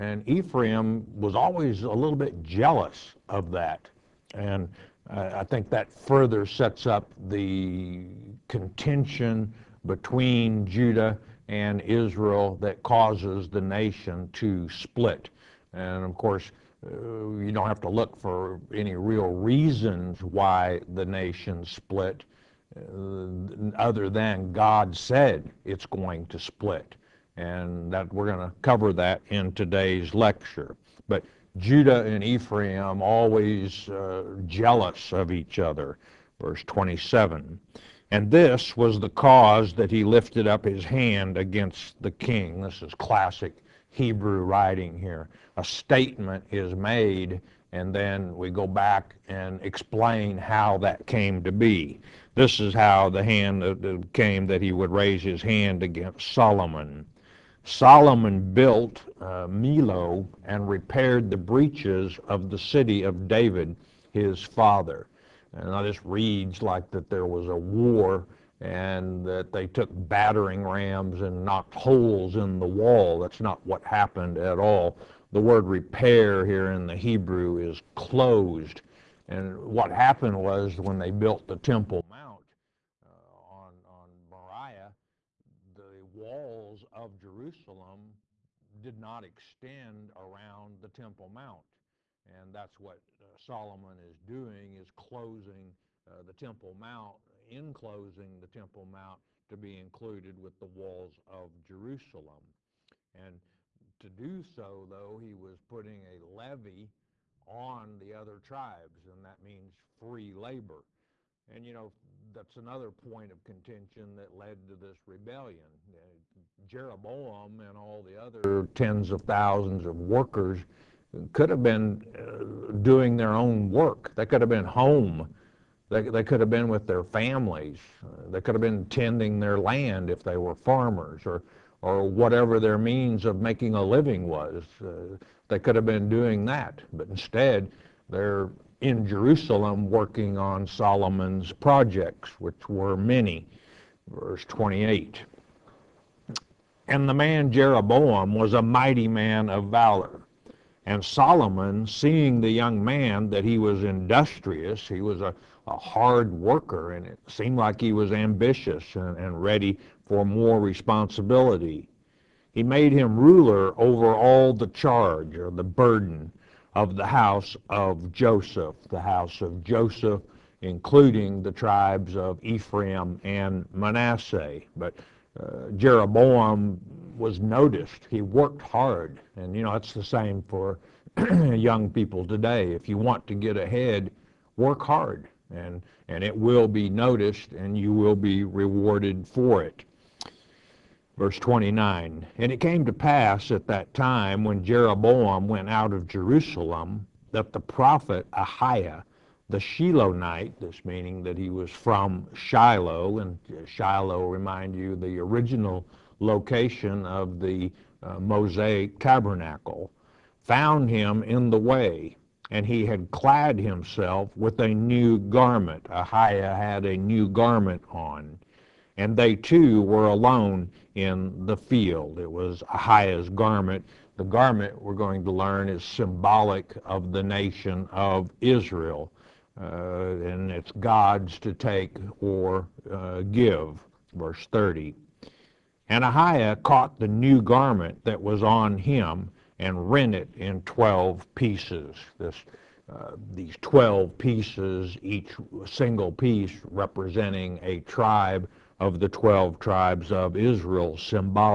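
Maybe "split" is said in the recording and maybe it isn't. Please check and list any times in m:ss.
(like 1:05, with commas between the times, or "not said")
0:14, 0:21, 0:26.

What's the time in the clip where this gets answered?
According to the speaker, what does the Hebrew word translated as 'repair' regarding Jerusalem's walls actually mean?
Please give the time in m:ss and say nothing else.
1:17.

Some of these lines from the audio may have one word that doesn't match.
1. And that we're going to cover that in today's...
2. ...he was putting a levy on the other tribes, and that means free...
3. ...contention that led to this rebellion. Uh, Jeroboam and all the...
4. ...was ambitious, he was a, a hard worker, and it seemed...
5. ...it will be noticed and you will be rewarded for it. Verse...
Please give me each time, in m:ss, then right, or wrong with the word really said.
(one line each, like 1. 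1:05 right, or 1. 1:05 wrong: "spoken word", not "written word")
1. 0:27 right
2. 1:45 right
3. 1:53 right
4. 2:33 wrong: "industrious", not "ambitious"
5. 3:06 right.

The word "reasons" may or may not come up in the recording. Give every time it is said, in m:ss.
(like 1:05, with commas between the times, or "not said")
0:19.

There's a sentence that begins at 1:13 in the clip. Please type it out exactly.
That's not what happened at all.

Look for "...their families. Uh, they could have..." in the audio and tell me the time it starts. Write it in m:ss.
2:06.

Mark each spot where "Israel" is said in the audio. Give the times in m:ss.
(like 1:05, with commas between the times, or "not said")
0:11, 3:48, 4:10.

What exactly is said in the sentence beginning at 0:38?
And this was the cause that he lifted up his hand against the king.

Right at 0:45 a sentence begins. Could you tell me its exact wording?
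A statement is made, and then we go back and explain how that came to be.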